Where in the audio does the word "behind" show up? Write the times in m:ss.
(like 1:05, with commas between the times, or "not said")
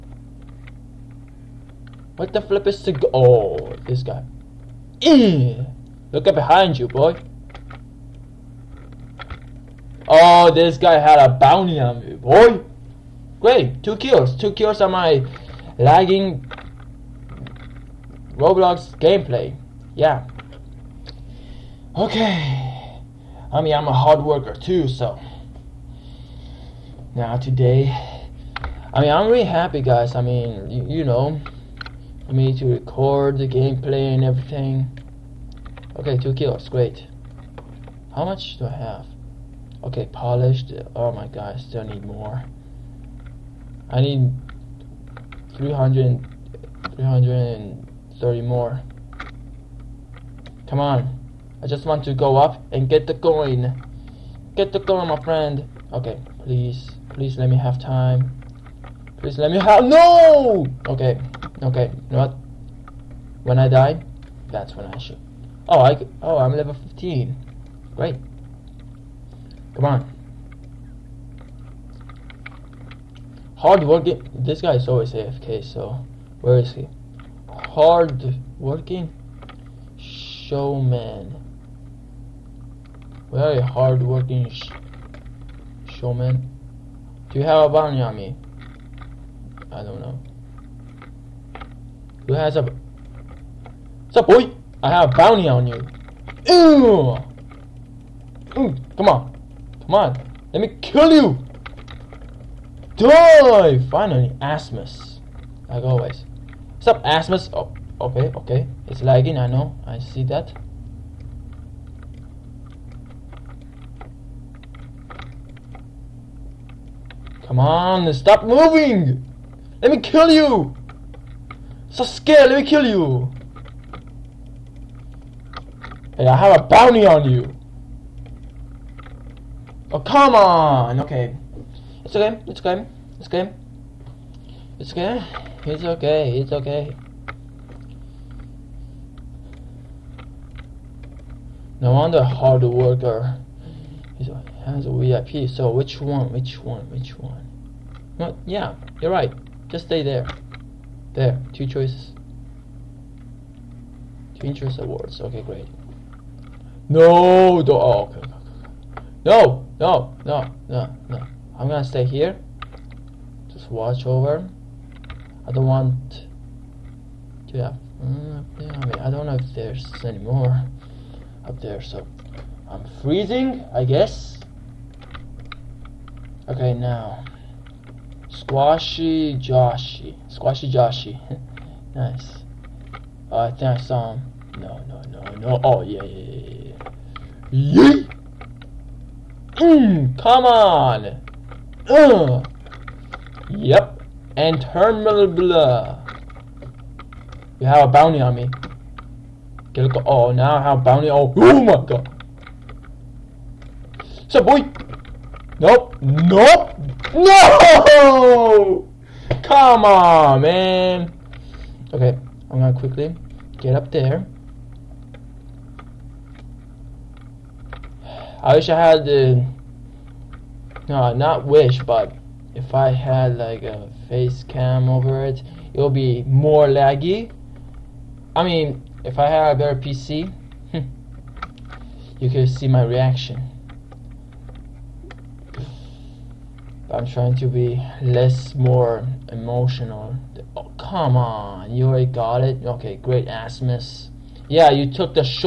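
0:06.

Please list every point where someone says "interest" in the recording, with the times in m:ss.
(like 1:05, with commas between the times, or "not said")
2:34.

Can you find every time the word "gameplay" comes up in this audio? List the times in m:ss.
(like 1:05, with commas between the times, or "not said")
0:18, 0:33.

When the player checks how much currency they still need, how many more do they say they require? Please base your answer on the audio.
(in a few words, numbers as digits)
330.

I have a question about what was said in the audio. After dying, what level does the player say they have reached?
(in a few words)
15.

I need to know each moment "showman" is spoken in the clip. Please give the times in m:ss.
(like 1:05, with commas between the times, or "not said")
1:19, 1:25.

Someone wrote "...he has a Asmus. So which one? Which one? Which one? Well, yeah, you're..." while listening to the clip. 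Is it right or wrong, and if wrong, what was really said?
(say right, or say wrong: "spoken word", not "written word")
wrong: "VIP", not "Asmus".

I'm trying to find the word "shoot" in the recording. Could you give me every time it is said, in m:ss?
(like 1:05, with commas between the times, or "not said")
1:04.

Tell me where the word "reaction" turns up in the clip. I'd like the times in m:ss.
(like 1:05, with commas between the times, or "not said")
3:52.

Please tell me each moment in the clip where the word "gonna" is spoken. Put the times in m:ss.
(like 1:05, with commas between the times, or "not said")
2:41, 3:32.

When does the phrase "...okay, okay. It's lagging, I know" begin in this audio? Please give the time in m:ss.
1:48.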